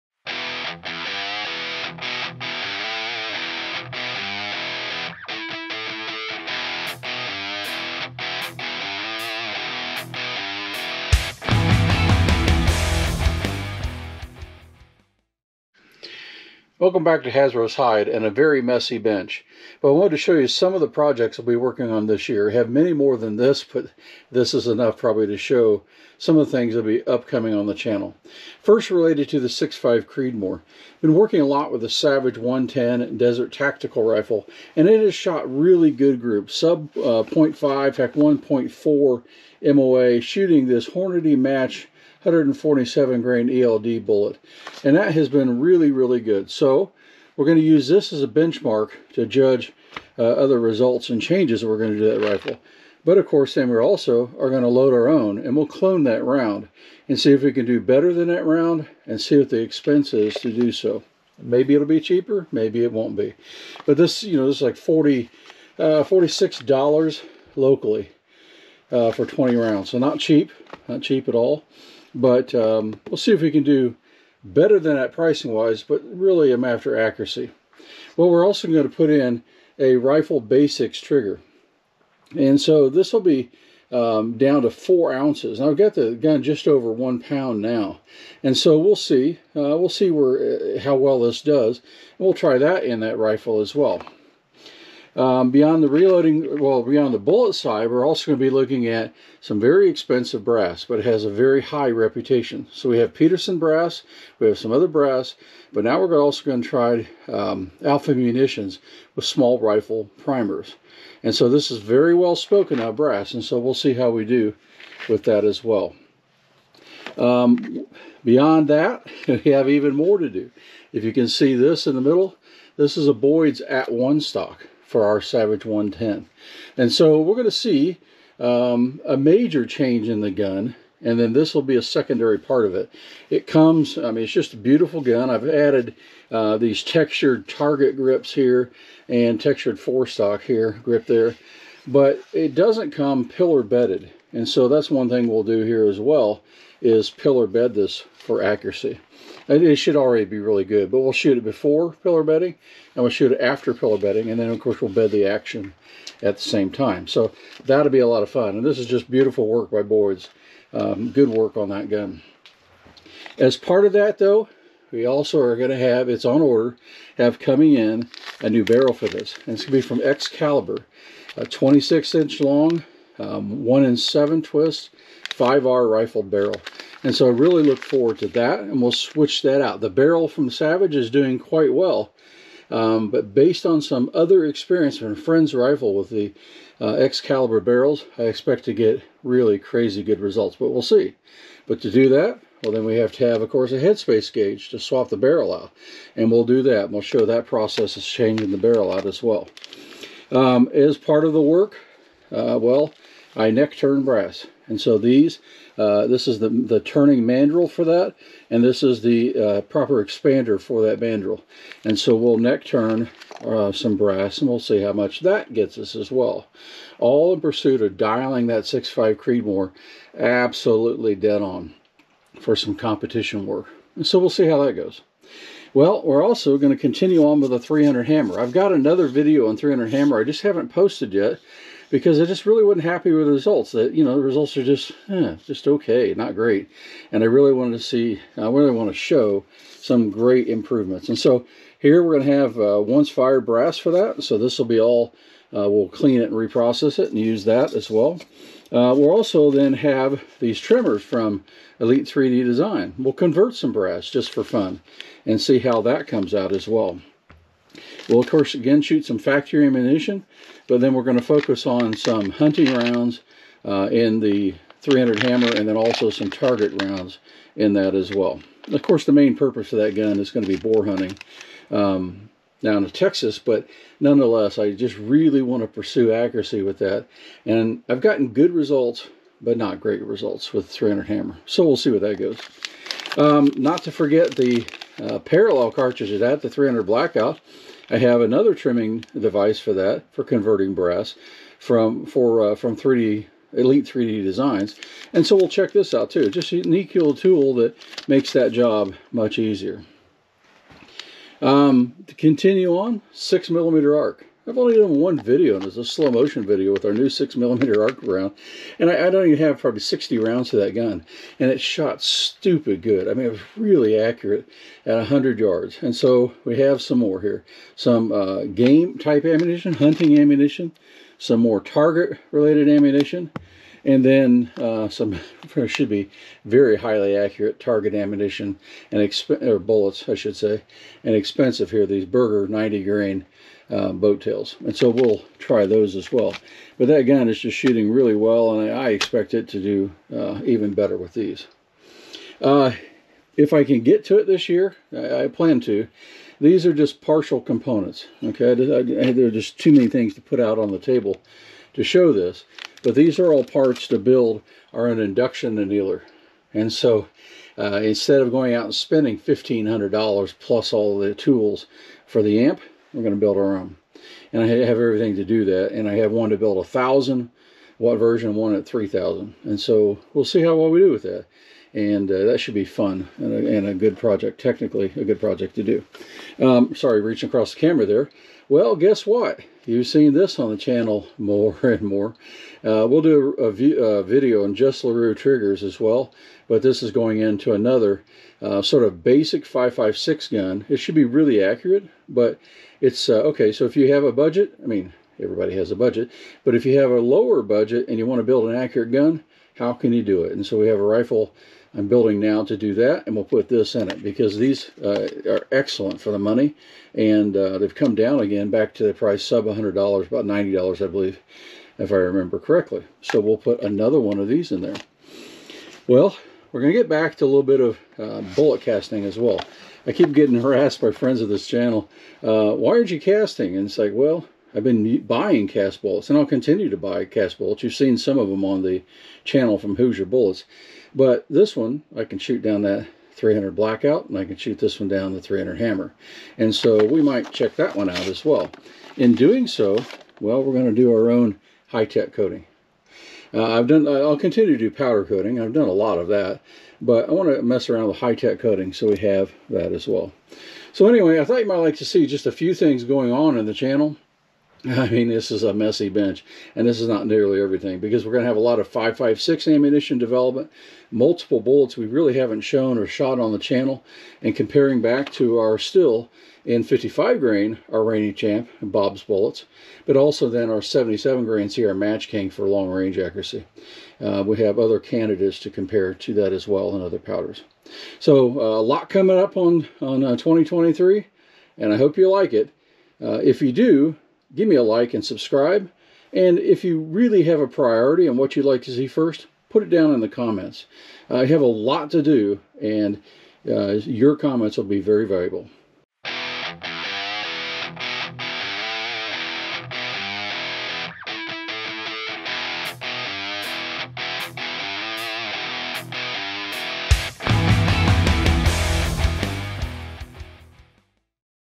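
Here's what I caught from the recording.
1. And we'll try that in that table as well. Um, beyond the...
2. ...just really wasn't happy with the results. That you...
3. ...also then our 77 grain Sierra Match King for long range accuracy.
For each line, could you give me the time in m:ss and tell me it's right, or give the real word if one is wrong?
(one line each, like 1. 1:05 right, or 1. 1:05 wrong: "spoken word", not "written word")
1. 1:31 wrong: "rifle", not "table"
2. 3:52 right
3. 7:49 right.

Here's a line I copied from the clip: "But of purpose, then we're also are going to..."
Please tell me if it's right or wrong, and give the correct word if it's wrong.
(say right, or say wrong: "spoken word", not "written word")
wrong: "course", not "purpose".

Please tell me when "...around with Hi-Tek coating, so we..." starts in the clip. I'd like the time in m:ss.
7:27.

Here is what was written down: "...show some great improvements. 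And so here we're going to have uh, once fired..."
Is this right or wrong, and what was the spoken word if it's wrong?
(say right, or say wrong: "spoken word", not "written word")
right.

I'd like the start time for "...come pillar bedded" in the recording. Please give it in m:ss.
2:22.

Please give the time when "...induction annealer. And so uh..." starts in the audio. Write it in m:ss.
5:54.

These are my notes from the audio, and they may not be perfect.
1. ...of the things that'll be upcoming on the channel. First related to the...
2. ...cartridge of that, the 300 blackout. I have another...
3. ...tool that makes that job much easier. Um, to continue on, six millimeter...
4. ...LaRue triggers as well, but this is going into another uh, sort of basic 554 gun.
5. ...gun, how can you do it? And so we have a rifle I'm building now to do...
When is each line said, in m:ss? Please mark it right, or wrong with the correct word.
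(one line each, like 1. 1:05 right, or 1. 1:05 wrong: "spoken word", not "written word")
1. 0:26 right
2. 4:45 right
3. 4:57 right
4. 6:24 wrong: "556", not "554"
5. 6:38 right.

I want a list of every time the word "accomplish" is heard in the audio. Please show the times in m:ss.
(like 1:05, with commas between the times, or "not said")
not said.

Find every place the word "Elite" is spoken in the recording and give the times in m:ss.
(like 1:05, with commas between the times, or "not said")
4:11, 4:53.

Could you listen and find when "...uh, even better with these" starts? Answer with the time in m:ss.
5:40.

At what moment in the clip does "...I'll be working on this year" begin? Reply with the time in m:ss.
0:21.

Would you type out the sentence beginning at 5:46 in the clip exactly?
These are just partial components, okay?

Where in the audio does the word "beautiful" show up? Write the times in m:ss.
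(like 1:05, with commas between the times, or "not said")
2:14, 2:39.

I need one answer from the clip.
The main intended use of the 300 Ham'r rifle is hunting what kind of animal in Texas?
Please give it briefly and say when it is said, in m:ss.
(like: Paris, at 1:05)
boar, at 4:30.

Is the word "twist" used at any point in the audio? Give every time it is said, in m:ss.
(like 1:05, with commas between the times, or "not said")
2:54.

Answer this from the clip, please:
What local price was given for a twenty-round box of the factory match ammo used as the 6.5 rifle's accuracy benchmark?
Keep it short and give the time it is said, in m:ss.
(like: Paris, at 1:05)
$46, at 1:06.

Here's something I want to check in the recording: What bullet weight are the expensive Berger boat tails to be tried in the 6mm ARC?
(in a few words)
90 grain.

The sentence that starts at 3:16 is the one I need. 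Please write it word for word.
We'll show that process is changing the barrel out as well.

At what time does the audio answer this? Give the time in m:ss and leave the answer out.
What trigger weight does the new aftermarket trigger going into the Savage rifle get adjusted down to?
1:24.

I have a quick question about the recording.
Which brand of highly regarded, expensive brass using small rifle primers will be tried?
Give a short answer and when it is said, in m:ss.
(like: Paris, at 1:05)
Alpha munitions, at 1:47.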